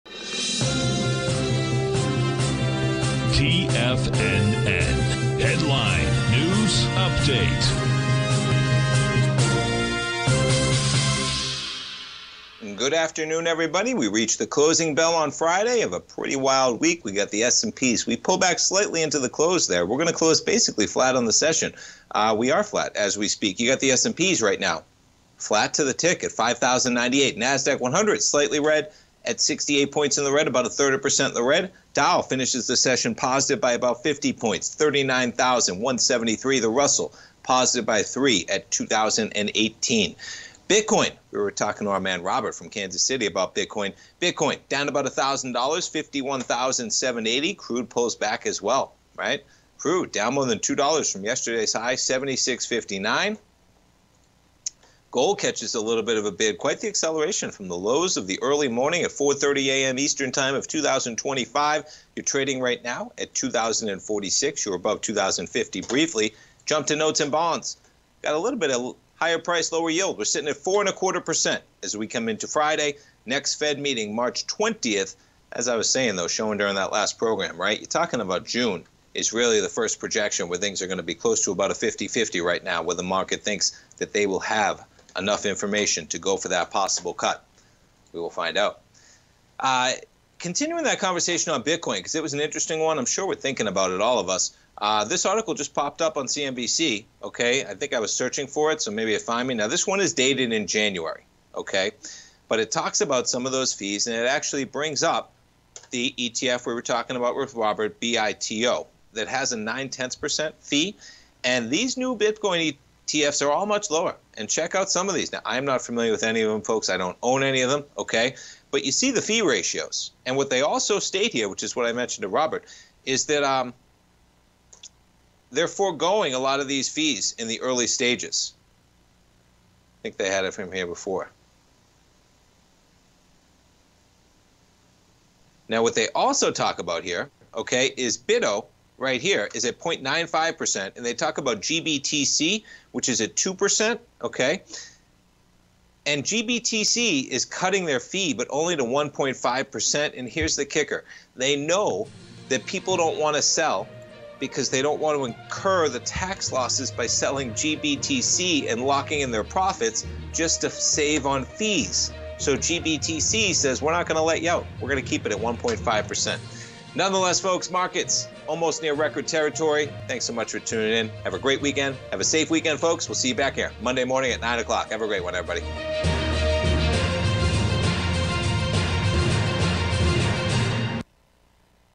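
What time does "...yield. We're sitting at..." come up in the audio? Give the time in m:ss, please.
1:09.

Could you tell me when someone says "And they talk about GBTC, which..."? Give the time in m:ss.
2:20.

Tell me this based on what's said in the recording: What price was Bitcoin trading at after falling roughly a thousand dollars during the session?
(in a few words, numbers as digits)
51,780.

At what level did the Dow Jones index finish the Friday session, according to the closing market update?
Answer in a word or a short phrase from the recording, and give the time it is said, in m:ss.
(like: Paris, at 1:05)
39,173, at 0:34.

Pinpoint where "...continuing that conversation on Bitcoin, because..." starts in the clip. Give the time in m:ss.
1:30.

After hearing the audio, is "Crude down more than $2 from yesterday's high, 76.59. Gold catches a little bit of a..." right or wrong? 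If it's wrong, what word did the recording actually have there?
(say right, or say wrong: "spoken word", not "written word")
right.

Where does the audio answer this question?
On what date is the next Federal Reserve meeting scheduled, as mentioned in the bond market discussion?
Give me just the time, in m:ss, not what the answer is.
1:14.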